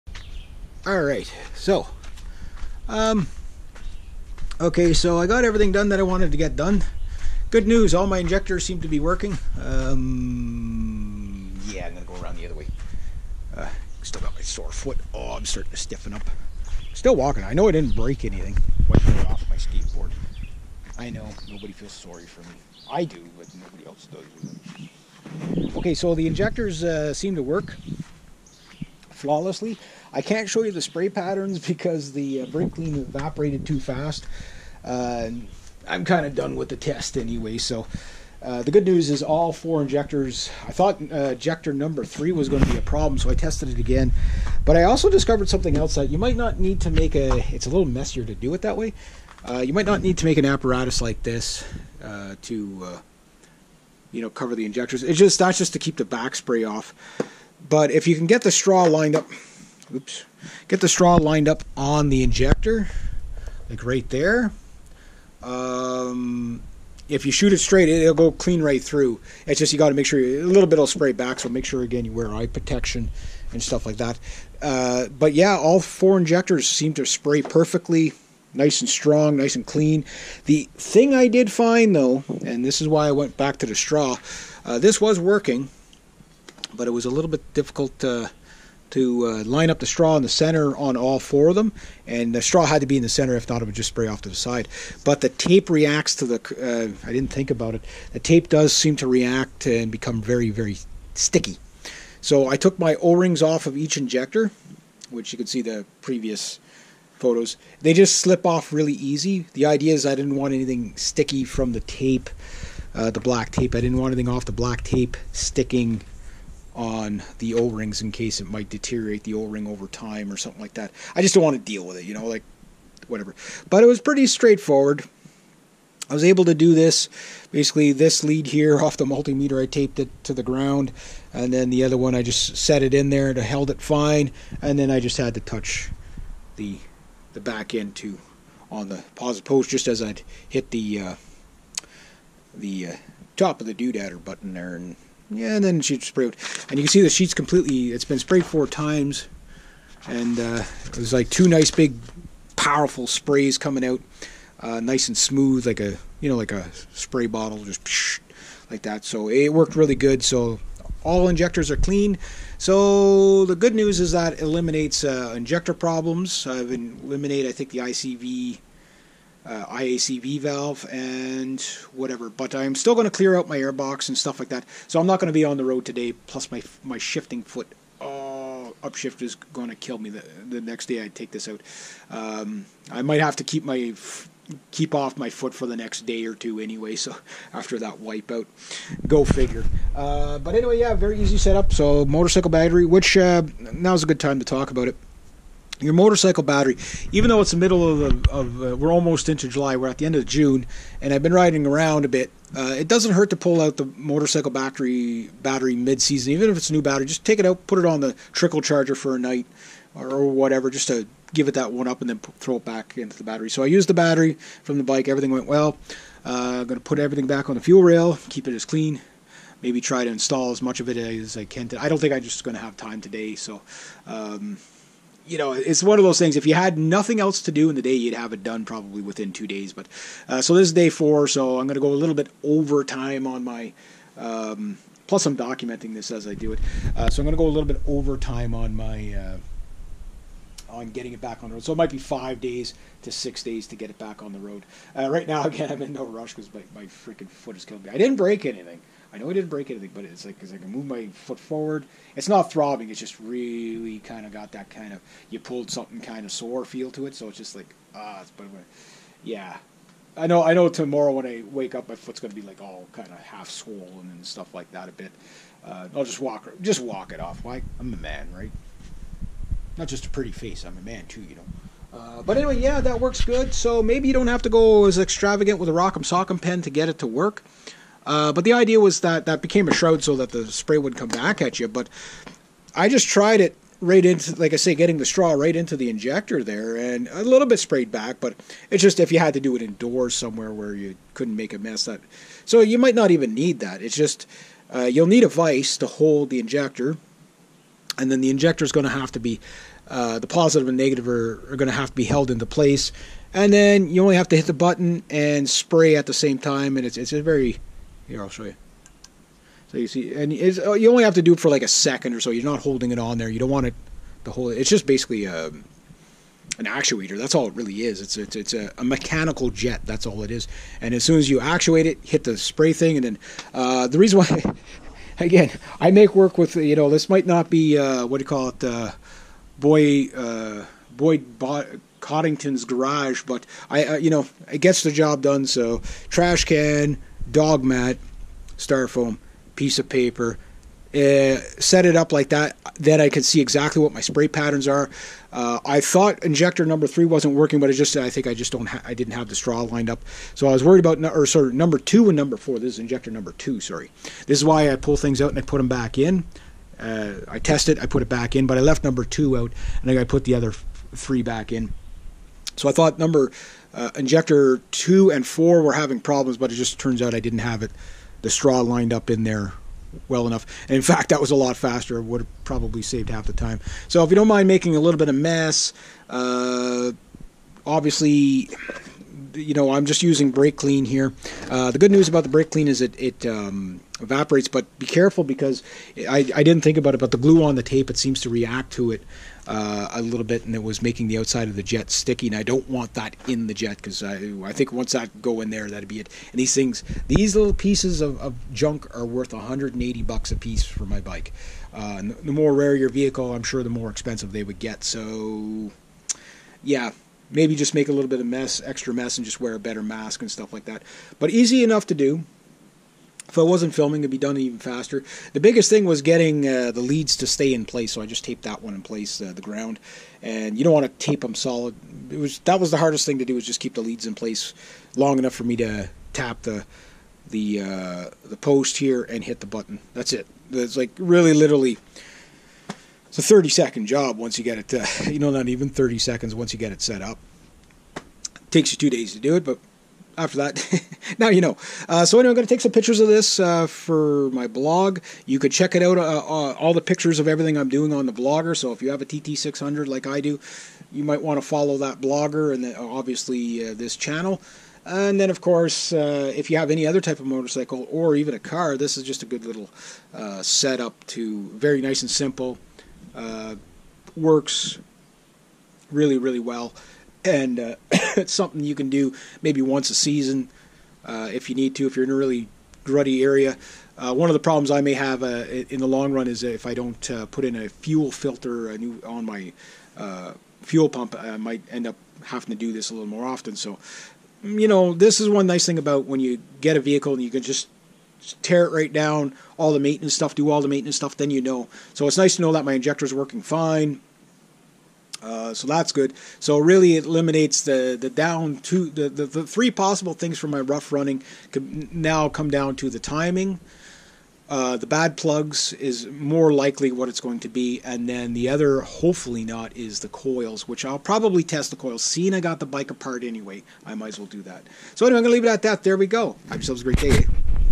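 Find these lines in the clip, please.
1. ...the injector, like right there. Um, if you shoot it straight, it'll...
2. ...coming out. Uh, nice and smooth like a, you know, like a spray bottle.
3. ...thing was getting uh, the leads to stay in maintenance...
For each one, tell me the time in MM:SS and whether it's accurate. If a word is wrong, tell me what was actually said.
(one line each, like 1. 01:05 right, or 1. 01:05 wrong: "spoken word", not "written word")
1. 01:02 right
2. 02:33 right
3. 06:55 wrong: "place", not "maintenance".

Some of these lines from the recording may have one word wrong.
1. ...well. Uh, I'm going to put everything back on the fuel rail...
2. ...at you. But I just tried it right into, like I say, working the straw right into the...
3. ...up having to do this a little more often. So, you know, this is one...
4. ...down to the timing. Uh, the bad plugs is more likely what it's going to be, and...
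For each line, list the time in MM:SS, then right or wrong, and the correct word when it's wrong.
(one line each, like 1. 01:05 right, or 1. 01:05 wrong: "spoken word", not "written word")
1. 03:35 right
2. 04:41 wrong: "getting", not "working"
3. 08:01 right
4. 08:22 right.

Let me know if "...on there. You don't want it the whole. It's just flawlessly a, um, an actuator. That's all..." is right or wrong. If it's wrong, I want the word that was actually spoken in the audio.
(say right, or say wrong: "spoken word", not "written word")
wrong: "basically", not "flawlessly".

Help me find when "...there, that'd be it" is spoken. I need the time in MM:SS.
06:35.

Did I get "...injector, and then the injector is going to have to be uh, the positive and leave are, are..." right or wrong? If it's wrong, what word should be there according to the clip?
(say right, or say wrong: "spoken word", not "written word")
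wrong: "negative", not "leave".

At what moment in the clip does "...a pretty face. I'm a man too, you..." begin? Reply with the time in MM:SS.
04:30.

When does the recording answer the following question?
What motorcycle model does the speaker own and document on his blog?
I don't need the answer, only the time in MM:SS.
07:29.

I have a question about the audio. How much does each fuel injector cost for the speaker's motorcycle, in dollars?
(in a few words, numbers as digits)
$180.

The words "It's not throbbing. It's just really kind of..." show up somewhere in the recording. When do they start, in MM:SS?
04:12.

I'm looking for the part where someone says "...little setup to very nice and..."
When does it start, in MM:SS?
07:39.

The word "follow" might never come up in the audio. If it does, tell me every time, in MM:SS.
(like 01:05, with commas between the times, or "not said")
07:31.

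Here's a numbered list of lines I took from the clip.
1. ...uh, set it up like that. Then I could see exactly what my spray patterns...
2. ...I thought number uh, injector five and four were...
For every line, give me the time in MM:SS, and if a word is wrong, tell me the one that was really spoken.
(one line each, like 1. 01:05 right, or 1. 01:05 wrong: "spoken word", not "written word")
1. 05:40 right
2. 06:02 wrong: "two", not "five".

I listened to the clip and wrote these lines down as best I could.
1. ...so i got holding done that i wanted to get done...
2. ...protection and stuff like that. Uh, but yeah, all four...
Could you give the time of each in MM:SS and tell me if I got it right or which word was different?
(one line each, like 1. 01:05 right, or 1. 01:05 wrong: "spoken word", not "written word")
1. 00:04 wrong: "everything", not "holding"
2. 01:12 right.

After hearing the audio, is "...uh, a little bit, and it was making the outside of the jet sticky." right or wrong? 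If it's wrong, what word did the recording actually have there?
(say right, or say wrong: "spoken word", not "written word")
right.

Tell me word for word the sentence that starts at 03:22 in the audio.
Uh, it doesn't hurt to pull out the motorcycle battery battery mid-season, even if it's a new battery.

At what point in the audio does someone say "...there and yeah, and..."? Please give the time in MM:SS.
02:24.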